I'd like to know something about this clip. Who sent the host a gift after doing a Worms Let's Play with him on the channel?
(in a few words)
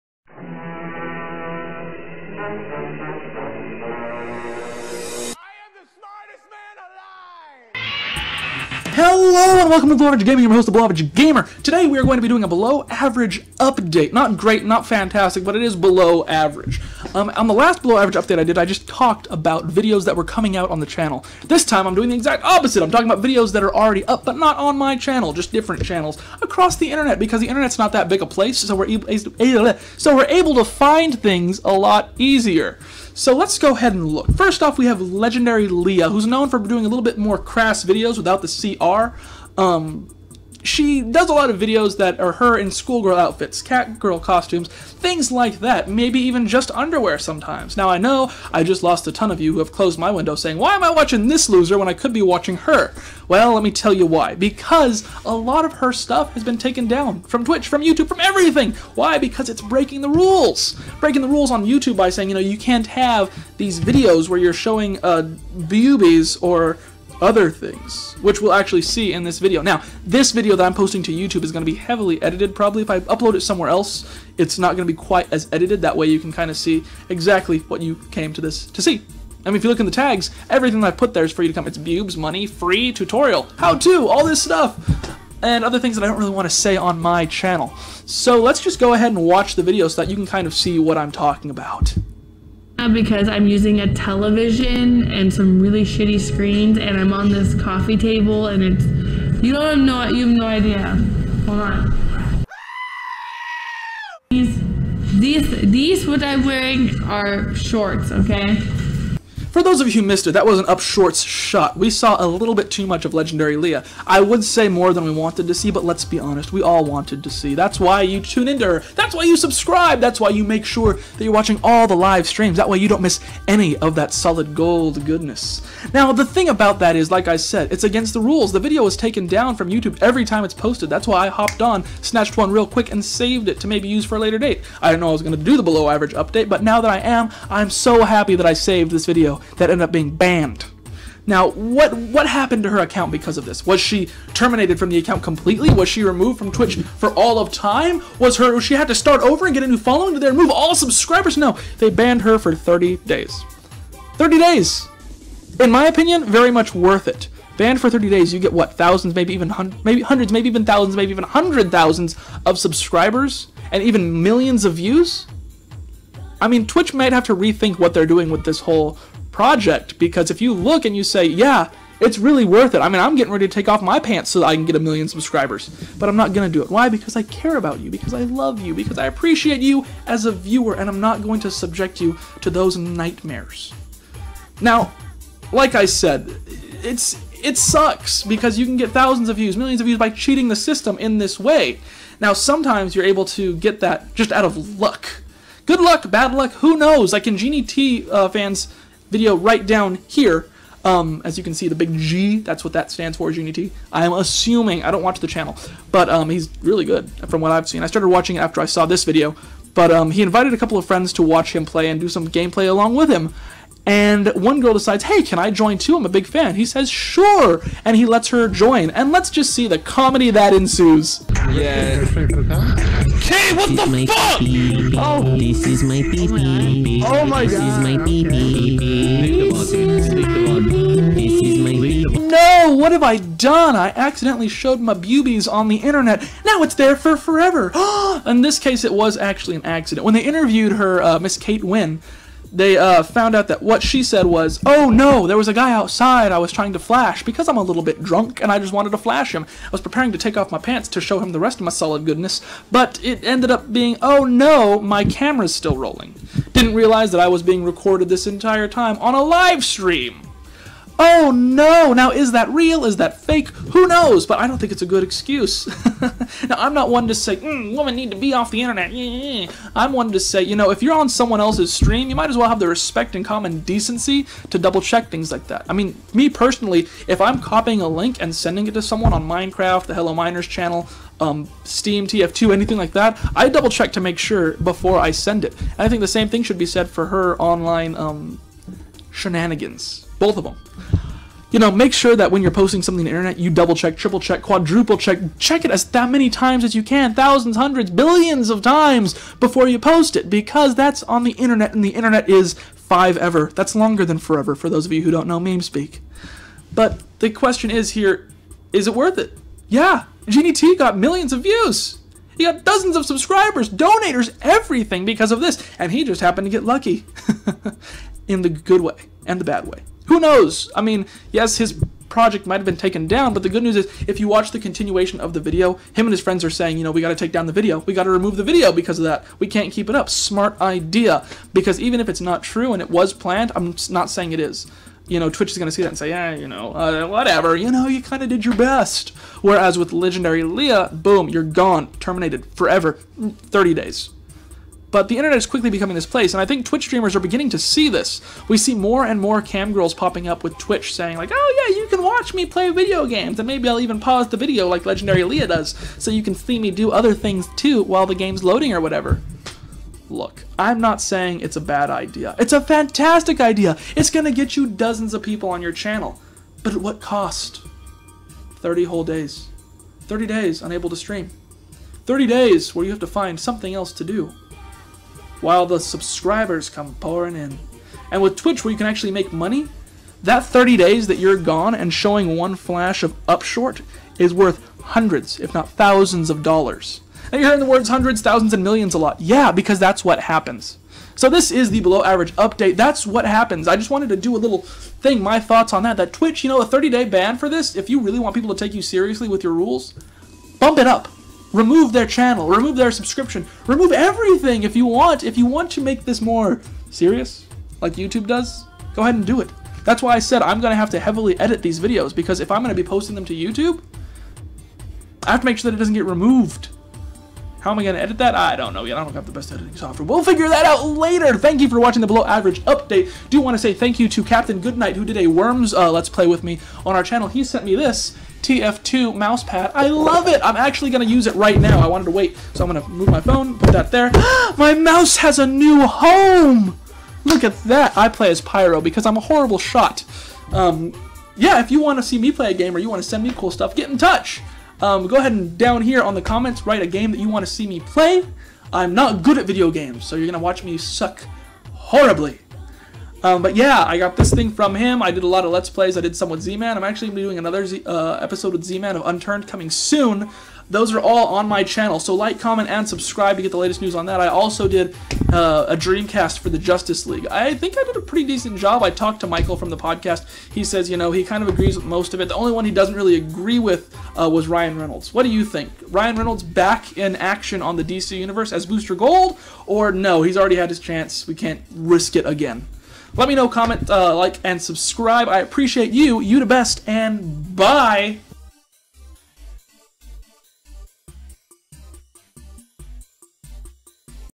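Captain Goodnight.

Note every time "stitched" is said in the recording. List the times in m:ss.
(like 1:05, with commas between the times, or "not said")
not said.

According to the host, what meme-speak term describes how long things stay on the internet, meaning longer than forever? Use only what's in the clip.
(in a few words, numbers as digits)
five ever.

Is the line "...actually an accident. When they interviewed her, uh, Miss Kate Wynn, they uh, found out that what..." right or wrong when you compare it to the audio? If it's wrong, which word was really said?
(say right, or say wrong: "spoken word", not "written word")
right.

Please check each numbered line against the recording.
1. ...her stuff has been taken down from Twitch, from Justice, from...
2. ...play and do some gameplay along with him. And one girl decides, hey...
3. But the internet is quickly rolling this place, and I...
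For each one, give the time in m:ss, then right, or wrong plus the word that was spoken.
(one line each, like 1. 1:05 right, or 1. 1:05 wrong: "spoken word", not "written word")
1. 0:55 wrong: "YouTube", not "Justice"
2. 3:31 right
3. 5:44 wrong: "becoming", not "rolling".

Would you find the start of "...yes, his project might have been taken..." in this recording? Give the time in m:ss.
5:21.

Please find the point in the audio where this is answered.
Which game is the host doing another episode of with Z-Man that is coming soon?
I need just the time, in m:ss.
7:39.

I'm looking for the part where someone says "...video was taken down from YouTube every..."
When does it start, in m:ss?
2:08.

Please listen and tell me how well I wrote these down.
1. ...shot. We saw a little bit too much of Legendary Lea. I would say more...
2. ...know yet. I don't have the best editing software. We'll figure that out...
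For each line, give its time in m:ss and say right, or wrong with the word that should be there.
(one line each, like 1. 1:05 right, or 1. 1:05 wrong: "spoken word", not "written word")
1. 1:51 right
2. 6:58 right.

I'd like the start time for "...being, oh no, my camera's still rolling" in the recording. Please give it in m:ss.
4:13.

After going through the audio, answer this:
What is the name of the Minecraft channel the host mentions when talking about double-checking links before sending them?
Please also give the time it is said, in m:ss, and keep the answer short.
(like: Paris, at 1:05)
Hello Miners, at 4:39.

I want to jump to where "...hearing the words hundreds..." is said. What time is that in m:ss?
6:27.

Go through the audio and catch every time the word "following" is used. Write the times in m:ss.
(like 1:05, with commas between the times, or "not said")
2:29.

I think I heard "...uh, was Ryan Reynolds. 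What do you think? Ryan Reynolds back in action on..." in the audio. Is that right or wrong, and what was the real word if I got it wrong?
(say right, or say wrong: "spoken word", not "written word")
right.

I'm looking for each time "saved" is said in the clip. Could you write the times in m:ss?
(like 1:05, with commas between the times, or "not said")
2:13, 2:18.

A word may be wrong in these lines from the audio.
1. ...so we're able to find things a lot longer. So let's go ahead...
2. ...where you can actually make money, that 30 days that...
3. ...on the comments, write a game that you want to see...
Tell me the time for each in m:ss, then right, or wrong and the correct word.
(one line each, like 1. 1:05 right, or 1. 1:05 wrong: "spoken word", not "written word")
1. 0:29 wrong: "easier", not "longer"
2. 6:18 right
3. 7:26 right.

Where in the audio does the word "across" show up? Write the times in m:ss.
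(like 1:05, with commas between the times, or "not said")
0:26.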